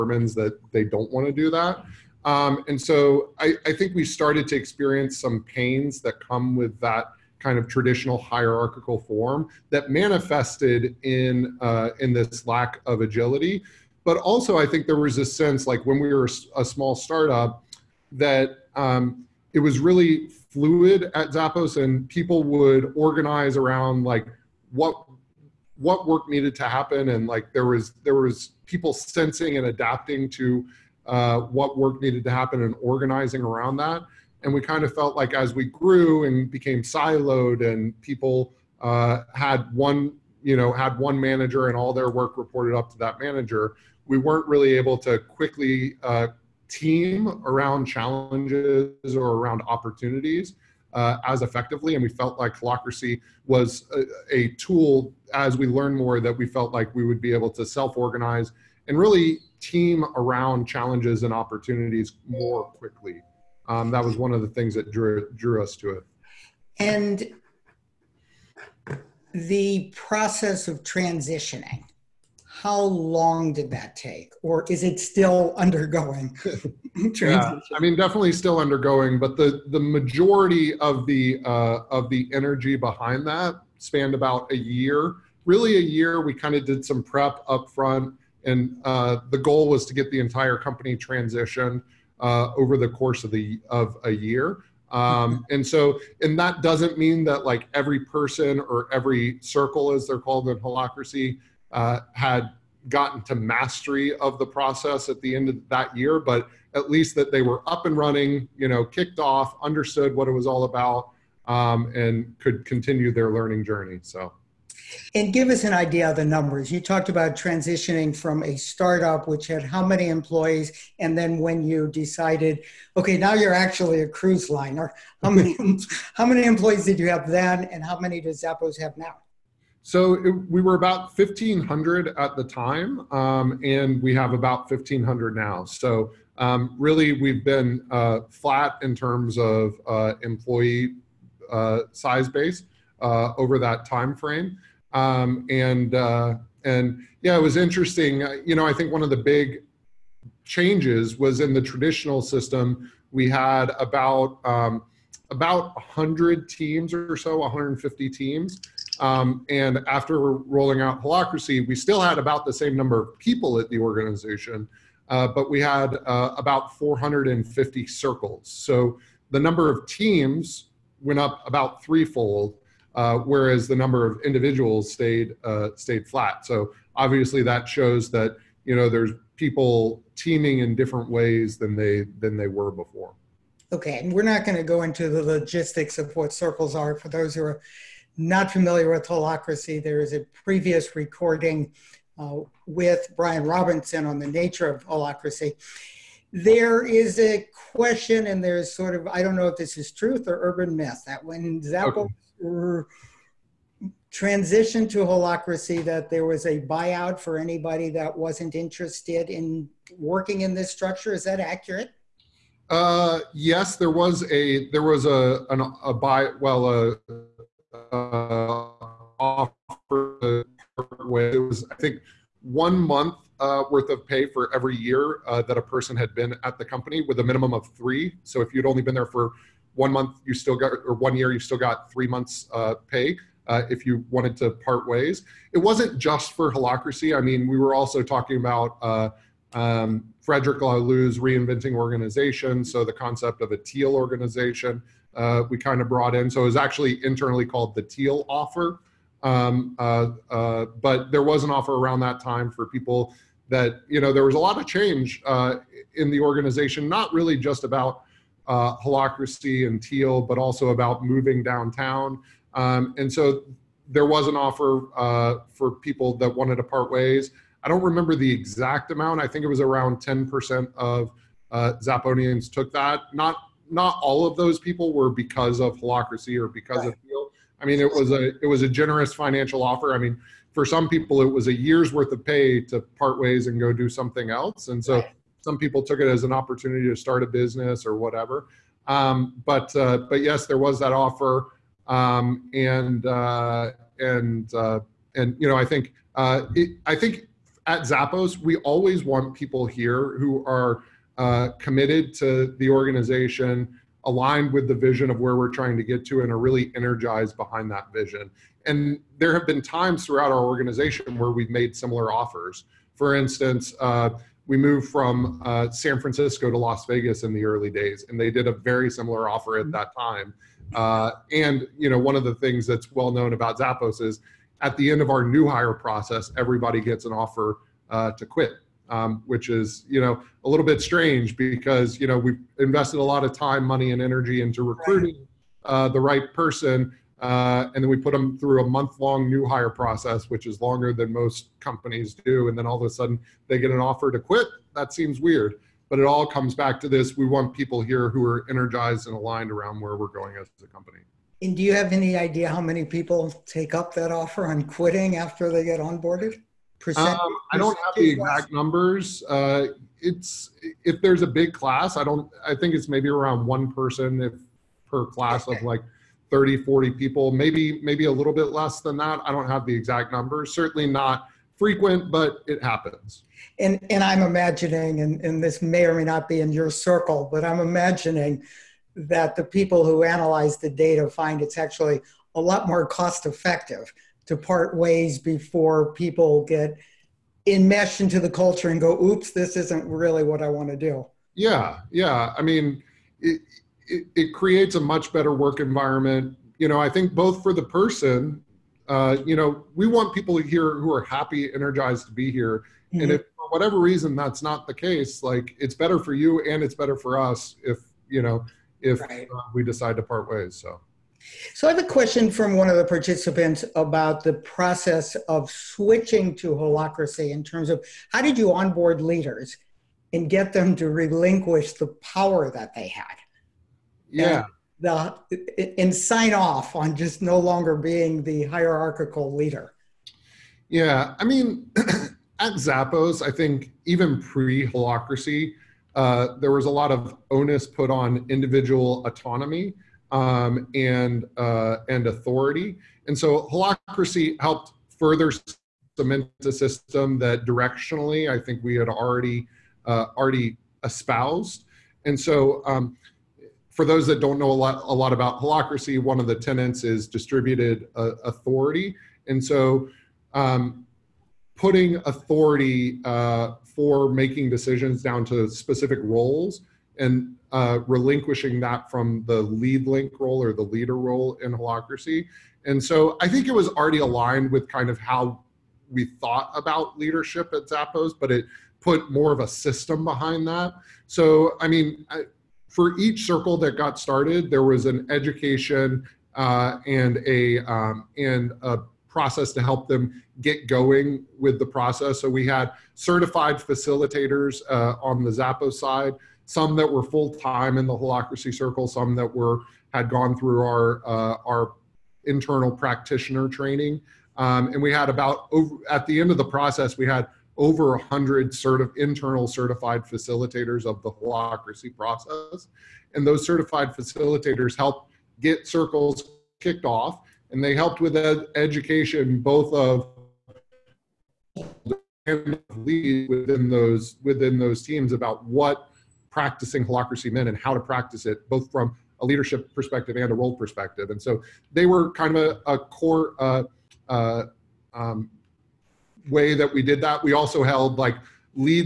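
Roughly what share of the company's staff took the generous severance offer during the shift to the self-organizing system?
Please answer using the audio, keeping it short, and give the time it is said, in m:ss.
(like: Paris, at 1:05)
10%, at 4:29.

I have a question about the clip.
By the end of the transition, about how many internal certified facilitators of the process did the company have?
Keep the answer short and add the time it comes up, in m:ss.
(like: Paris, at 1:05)
100, at 8:27.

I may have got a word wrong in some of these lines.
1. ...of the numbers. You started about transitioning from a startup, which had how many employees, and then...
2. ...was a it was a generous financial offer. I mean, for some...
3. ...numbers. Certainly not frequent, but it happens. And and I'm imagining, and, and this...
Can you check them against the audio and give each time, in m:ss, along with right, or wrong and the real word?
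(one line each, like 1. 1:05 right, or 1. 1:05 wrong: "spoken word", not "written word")
1. 1:56 wrong: "talked", not "started"
2. 4:37 right
3. 6:10 right.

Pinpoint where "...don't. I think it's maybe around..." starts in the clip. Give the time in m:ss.
6:02.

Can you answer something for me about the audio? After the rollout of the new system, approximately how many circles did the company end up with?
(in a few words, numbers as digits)
450.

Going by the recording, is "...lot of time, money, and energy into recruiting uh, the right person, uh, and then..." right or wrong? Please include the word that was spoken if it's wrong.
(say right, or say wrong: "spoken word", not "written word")
right.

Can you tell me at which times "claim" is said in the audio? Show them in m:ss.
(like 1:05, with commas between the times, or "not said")
not said.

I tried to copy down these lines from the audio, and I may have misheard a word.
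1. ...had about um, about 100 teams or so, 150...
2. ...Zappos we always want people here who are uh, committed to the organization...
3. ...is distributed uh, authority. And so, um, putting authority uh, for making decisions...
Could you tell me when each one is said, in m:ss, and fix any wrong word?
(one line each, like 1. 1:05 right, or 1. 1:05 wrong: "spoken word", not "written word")
1. 2:33 right
2. 4:57 right
3. 7:36 right.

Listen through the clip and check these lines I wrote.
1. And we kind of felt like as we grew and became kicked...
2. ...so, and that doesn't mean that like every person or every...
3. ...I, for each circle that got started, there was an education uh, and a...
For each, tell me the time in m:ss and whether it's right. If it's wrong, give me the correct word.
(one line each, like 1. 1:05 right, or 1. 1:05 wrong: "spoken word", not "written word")
1. 0:34 wrong: "siloed", not "kicked"
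2. 1:35 right
3. 8:02 right.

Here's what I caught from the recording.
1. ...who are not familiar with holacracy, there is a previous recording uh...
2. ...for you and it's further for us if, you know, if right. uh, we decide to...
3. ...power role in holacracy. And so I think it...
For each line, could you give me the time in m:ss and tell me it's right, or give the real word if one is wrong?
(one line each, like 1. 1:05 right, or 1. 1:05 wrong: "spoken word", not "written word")
1. 3:07 right
2. 6:45 wrong: "better", not "further"
3. 7:50 wrong: "leader", not "power".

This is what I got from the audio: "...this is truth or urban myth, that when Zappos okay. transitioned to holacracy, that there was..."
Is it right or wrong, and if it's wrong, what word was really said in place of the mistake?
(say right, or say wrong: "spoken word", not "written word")
right.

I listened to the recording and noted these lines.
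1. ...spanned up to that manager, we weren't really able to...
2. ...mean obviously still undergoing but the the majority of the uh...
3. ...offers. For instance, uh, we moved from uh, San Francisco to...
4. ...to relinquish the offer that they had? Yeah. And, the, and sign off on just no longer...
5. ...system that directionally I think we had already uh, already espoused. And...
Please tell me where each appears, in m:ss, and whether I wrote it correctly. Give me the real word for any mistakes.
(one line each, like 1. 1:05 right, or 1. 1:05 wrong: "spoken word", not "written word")
1. 0:42 wrong: "reported", not "spanned"
2. 1:17 wrong: "definitely", not "obviously"
3. 5:12 right
4. 7:00 wrong: "power", not "offer"
5. 7:26 right.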